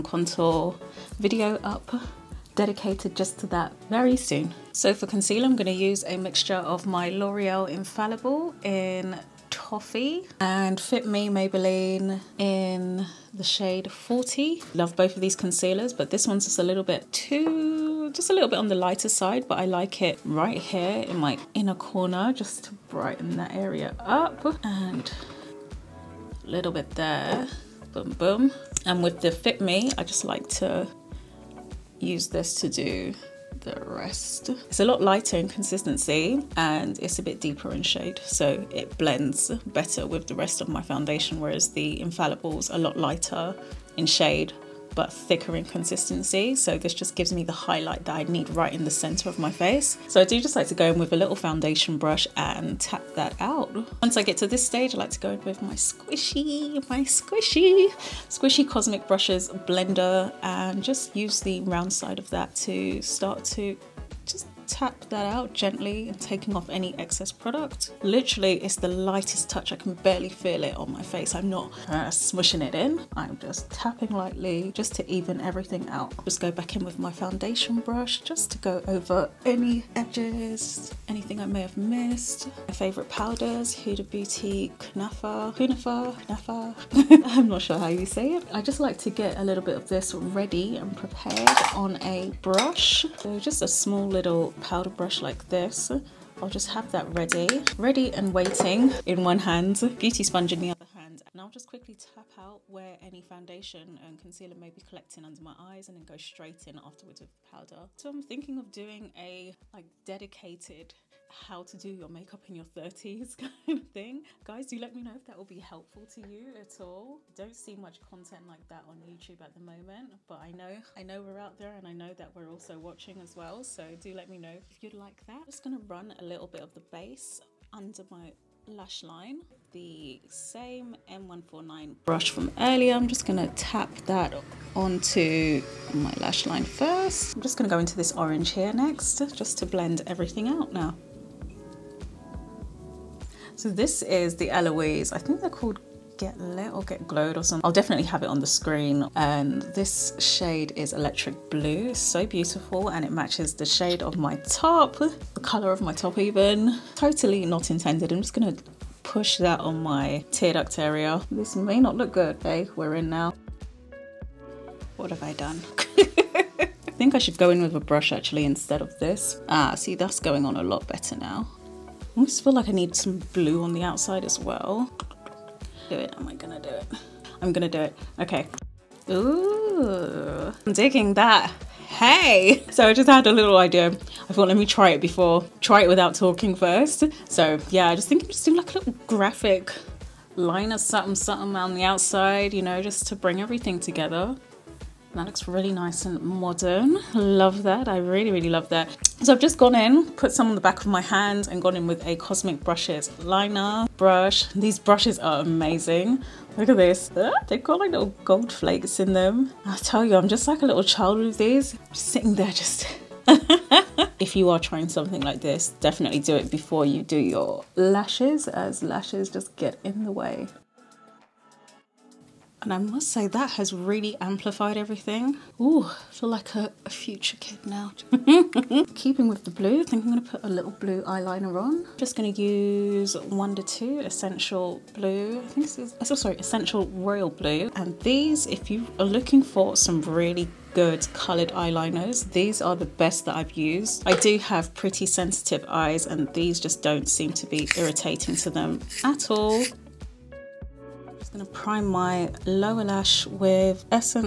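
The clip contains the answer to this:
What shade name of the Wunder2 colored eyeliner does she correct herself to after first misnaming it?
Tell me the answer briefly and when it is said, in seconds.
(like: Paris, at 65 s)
Essential Royal Blue, at 236 s.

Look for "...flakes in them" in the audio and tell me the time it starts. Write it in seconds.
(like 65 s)
208 s.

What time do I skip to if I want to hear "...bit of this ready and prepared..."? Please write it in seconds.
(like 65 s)
89 s.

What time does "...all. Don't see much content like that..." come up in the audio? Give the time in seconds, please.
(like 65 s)
116 s.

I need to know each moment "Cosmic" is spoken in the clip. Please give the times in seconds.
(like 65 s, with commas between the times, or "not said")
58 s, 202 s.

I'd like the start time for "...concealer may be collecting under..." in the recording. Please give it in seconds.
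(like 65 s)
104 s.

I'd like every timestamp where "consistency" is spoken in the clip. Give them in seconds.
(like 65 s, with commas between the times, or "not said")
35 s, 45 s.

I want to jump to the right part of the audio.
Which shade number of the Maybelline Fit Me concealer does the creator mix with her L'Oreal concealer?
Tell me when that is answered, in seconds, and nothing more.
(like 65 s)
13 s.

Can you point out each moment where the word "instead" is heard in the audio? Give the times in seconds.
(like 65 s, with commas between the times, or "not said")
168 s.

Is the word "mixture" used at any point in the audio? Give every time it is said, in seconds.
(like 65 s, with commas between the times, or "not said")
6 s.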